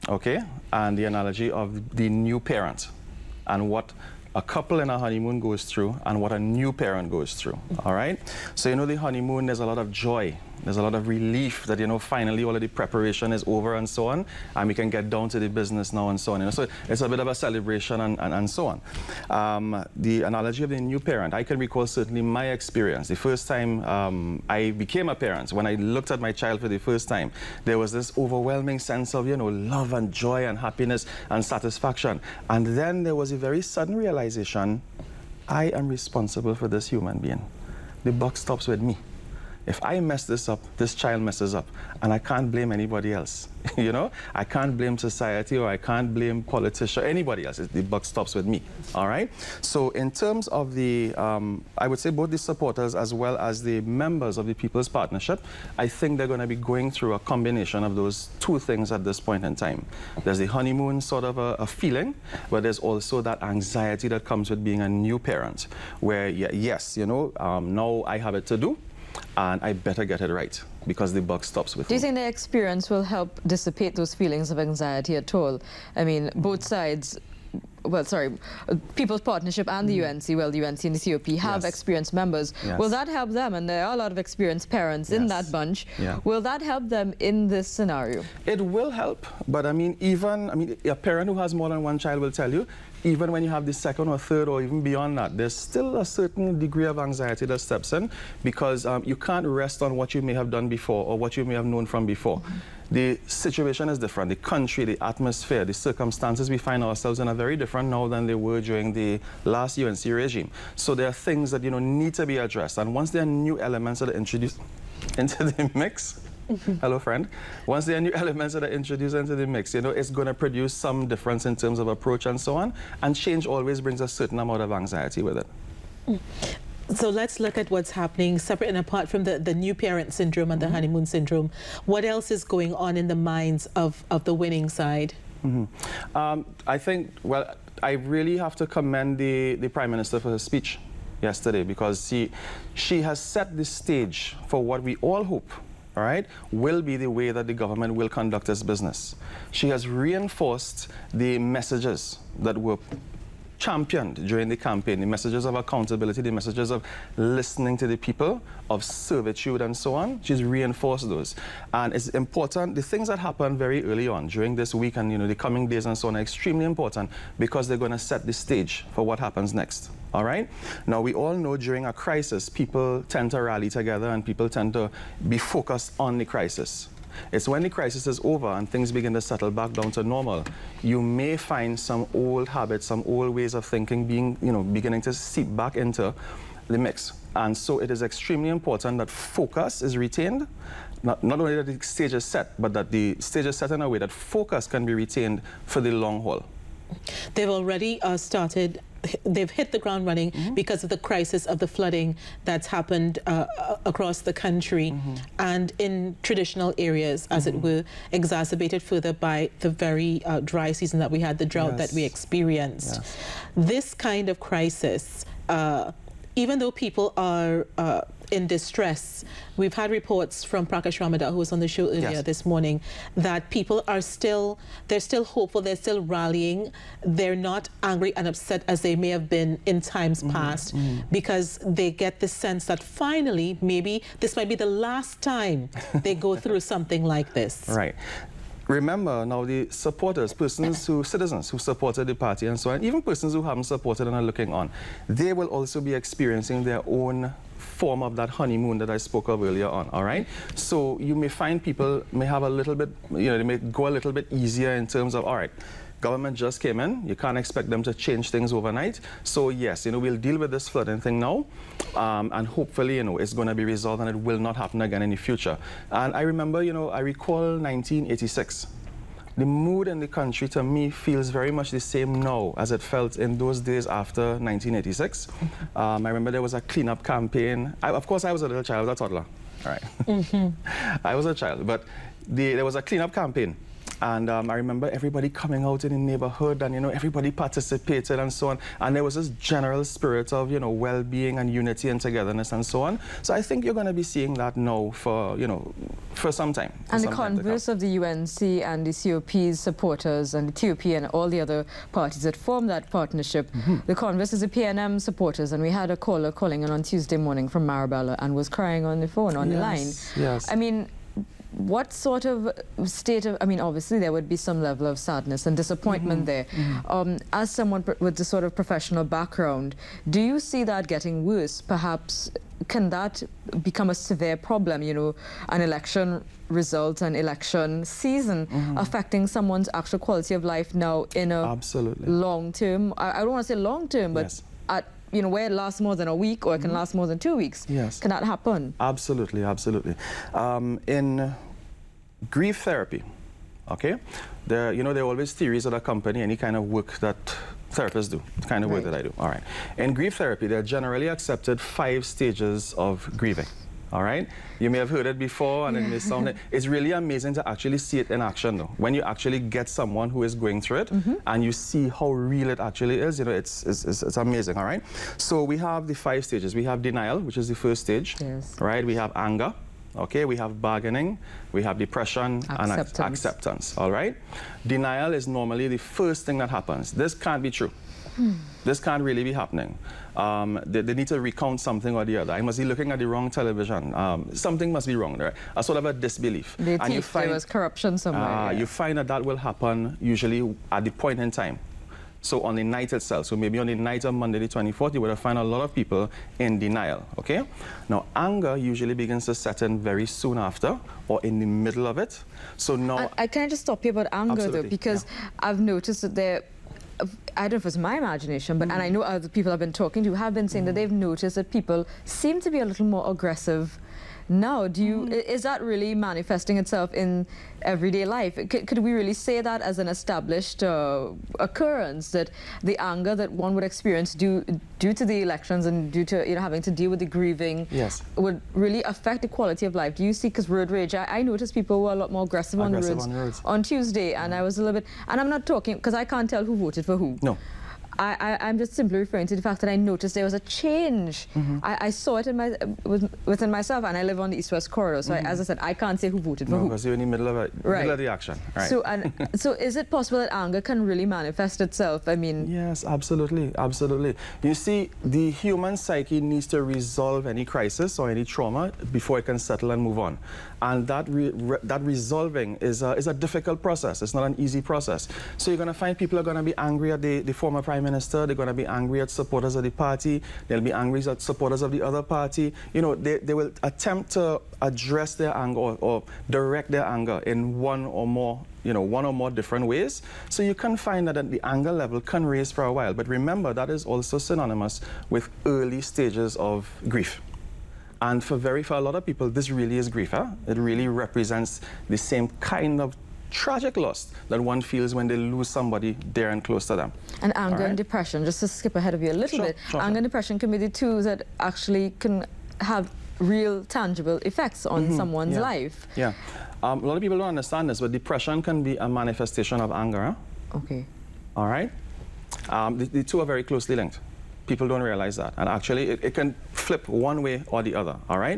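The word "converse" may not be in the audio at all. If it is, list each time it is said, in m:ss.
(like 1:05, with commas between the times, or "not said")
4:57, 5:03.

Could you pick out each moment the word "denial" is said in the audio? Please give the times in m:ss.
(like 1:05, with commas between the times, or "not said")
6:06, 6:14, 6:36.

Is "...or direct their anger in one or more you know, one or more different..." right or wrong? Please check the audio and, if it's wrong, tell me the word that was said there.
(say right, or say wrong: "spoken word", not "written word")
right.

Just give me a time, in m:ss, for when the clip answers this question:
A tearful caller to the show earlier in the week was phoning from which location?
5:07.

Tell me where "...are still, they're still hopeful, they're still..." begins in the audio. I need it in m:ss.
3:43.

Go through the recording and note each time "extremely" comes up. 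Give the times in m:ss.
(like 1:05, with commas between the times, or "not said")
2:46, 3:08.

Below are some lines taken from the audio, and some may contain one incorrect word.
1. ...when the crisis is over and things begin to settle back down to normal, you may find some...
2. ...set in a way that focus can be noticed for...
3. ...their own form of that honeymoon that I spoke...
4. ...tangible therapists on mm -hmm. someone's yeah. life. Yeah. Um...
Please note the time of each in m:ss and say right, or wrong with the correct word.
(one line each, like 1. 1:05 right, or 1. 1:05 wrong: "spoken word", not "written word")
1. 2:57 right
2. 3:13 wrong: "retained", not "noticed"
3. 4:06 right
4. 8:23 wrong: "effects", not "therapists".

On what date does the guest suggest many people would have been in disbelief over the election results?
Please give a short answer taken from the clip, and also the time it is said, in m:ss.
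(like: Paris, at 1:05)
Monday the 24th, at 6:34.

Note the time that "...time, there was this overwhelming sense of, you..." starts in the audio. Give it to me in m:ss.
0:27.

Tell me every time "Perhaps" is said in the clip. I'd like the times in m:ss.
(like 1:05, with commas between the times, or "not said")
5:21.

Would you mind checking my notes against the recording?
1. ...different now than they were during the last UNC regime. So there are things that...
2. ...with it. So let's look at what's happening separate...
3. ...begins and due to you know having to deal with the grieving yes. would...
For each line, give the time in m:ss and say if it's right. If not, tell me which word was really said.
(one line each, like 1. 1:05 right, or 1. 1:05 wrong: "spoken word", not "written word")
1. 1:47 right
2. 2:05 right
3. 7:05 wrong: "elections", not "begins".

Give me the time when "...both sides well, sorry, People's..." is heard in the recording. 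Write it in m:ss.
1:16.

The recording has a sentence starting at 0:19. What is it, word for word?
Um, the analogy of the new parent, I can recall certainly my experience.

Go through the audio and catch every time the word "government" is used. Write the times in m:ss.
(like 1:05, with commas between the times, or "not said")
2:27, 4:15.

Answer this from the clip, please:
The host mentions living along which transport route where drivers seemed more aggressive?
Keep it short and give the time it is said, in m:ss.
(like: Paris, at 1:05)
East West corridor, at 7:24.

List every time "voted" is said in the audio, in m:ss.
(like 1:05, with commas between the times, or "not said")
7:16, 7:26.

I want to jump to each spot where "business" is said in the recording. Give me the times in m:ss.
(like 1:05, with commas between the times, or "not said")
0:15, 2:28.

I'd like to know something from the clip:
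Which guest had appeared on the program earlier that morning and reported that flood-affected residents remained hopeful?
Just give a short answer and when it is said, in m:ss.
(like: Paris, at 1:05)
Prakash Ramadhar, at 3:40.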